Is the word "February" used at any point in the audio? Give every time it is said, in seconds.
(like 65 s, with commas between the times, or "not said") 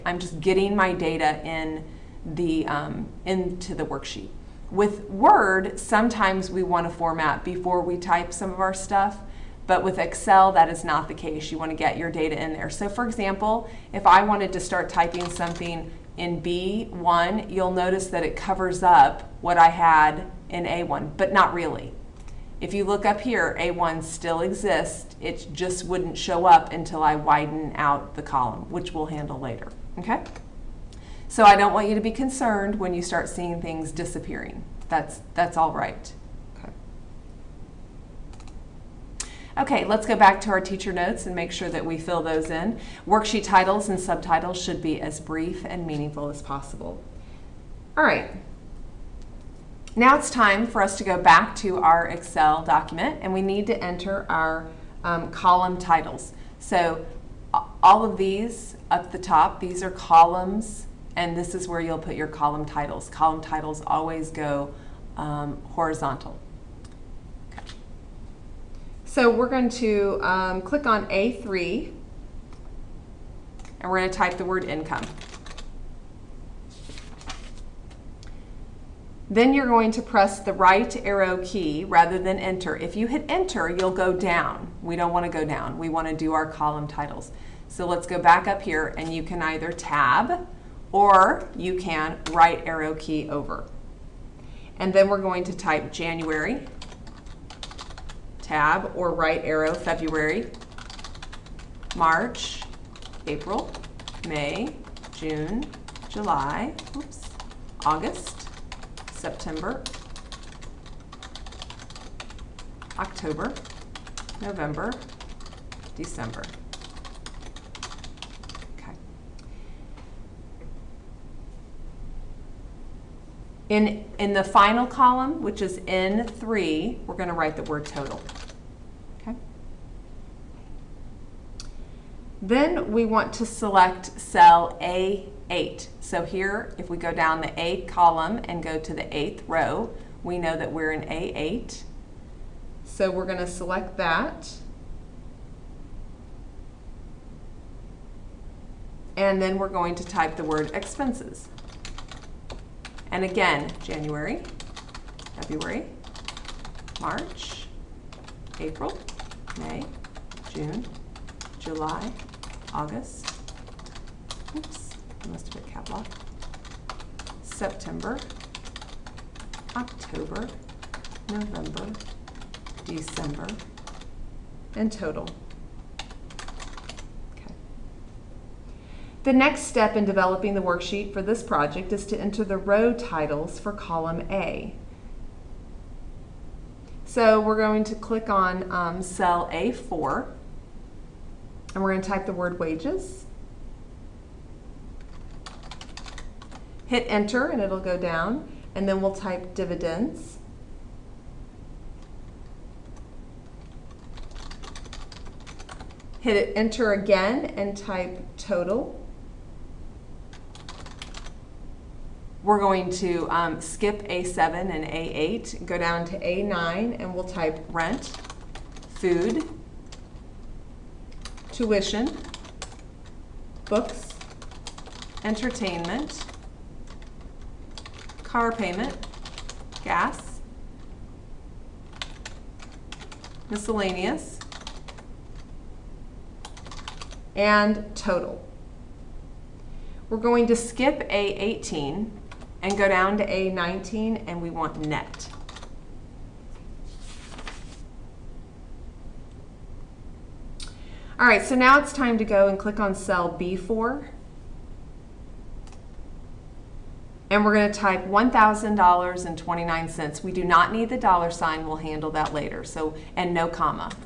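99 s, 155 s.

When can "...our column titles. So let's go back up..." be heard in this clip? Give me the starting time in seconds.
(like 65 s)
86 s.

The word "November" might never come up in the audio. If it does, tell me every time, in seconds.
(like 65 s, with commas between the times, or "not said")
114 s, 171 s.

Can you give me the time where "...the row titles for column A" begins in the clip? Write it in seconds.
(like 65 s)
182 s.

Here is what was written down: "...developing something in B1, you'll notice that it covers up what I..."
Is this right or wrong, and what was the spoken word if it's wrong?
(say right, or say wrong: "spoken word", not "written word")
wrong: "typing", not "developing".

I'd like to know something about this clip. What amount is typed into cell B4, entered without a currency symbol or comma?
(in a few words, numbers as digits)
1000.29.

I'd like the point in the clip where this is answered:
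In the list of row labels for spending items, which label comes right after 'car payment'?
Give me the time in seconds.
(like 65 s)
229 s.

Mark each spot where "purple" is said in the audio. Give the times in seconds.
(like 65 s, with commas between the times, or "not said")
not said.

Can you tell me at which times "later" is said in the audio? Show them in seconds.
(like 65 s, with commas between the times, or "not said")
29 s, 262 s.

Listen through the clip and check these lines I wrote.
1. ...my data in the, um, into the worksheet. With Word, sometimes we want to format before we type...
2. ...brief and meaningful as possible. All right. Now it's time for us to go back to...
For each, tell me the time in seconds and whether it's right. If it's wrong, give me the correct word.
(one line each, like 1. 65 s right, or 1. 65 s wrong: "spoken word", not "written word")
1. 0 s right
2. 45 s right.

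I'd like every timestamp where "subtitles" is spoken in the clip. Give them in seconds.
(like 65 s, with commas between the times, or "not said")
43 s.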